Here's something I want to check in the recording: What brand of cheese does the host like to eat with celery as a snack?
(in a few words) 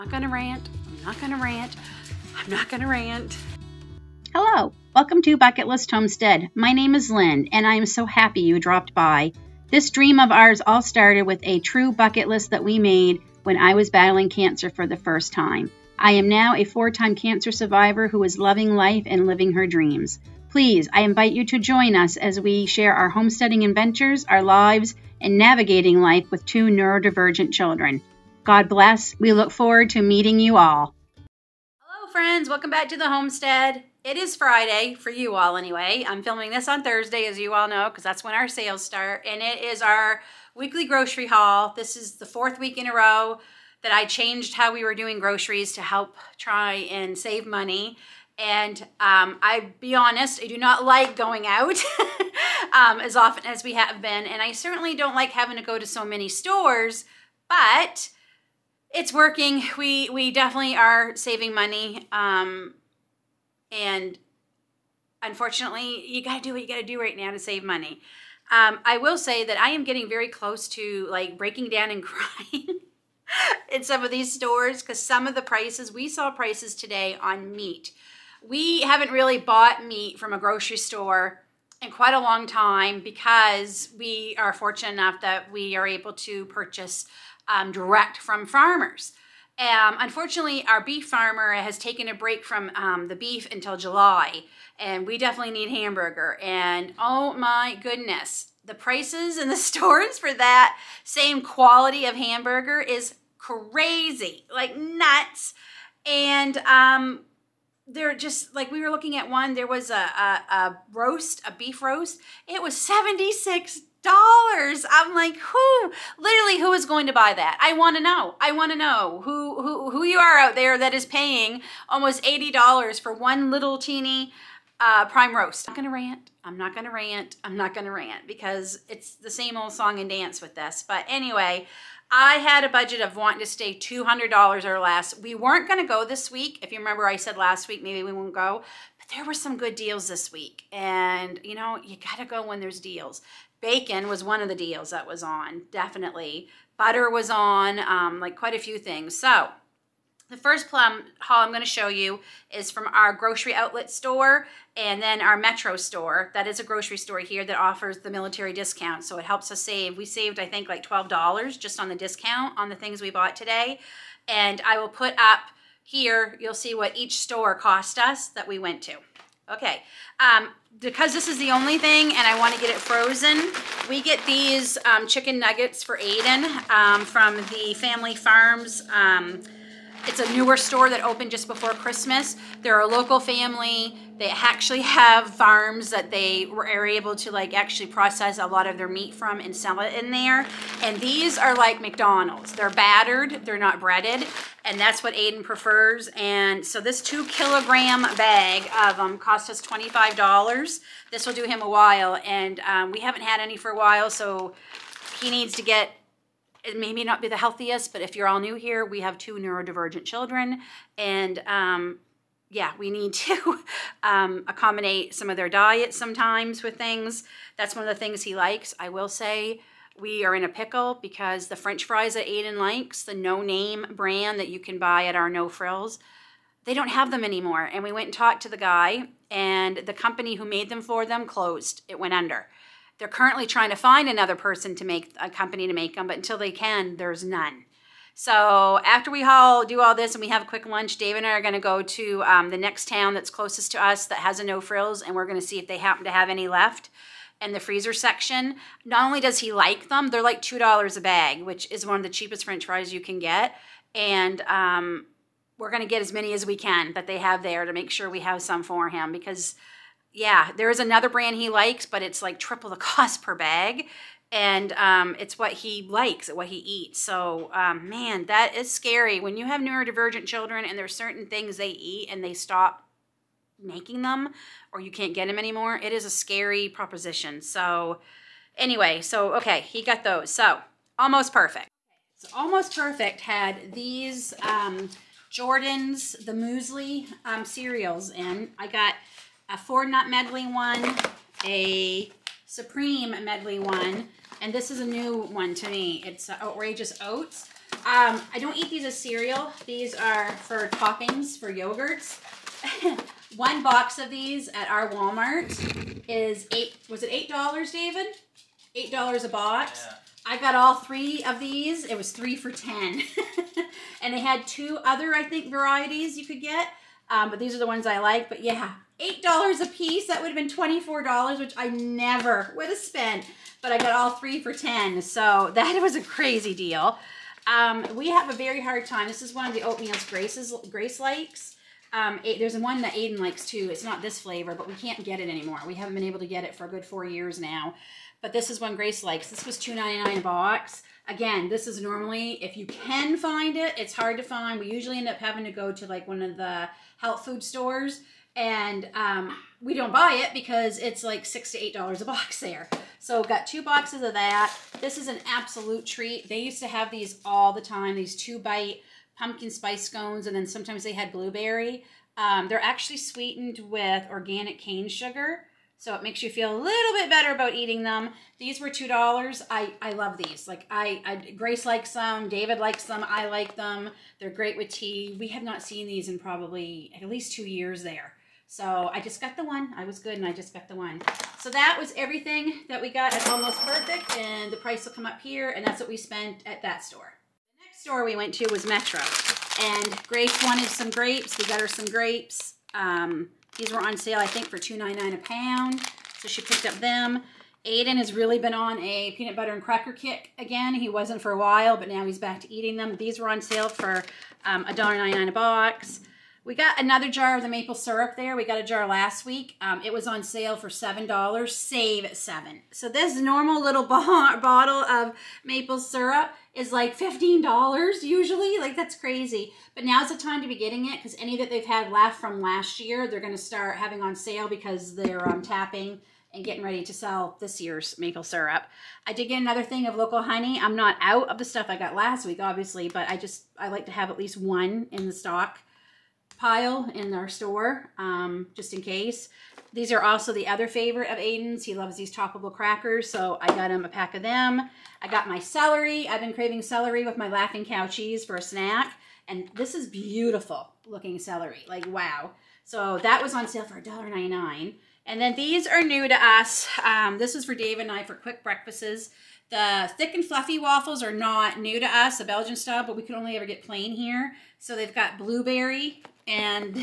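Laughing Cow.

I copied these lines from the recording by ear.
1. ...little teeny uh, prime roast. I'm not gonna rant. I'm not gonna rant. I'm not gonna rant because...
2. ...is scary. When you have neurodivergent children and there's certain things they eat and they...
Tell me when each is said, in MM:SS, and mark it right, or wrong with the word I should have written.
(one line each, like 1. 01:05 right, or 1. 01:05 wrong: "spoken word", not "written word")
1. 02:03 right
2. 04:28 right.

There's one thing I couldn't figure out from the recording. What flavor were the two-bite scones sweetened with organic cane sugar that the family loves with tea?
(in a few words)
Pumpkin spice.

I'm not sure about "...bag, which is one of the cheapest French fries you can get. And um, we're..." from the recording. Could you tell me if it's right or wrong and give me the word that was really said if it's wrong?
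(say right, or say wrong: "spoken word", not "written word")
right.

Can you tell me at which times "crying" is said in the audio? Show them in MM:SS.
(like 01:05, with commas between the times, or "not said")
01:12.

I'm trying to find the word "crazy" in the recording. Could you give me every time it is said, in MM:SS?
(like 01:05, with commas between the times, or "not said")
01:43, 05:26, 06:58.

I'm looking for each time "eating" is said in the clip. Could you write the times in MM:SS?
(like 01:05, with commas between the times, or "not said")
06:07, 06:42.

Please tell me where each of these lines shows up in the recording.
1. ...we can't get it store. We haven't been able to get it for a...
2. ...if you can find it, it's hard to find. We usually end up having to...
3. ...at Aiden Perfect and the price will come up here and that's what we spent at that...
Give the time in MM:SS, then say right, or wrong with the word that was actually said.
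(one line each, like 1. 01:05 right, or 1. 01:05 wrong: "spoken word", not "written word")
1. 05:34 wrong: "anymore", not "store"
2. 05:42 right
3. 06:23 wrong: "Almost", not "Aiden".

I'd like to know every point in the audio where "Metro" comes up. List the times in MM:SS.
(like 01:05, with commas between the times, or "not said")
02:35, 06:28.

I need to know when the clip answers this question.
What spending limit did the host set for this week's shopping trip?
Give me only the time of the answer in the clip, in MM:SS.
02:13.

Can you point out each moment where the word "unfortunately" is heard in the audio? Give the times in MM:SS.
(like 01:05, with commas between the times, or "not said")
01:05, 01:29.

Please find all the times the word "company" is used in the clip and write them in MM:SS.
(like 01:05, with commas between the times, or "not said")
03:49, 03:55.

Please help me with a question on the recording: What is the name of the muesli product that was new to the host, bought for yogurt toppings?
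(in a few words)
Outrageous Oats.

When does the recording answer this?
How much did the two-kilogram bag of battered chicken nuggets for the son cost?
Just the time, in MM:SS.
03:19.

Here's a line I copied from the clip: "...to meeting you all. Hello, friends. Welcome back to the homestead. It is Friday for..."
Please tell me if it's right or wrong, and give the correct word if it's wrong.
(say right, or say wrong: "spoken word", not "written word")
right.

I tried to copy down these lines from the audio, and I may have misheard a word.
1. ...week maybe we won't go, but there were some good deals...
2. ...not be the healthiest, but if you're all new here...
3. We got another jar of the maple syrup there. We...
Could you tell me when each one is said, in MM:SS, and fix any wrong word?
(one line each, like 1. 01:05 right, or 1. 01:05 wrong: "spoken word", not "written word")
1. 02:17 right
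2. 03:27 right
3. 06:46 right.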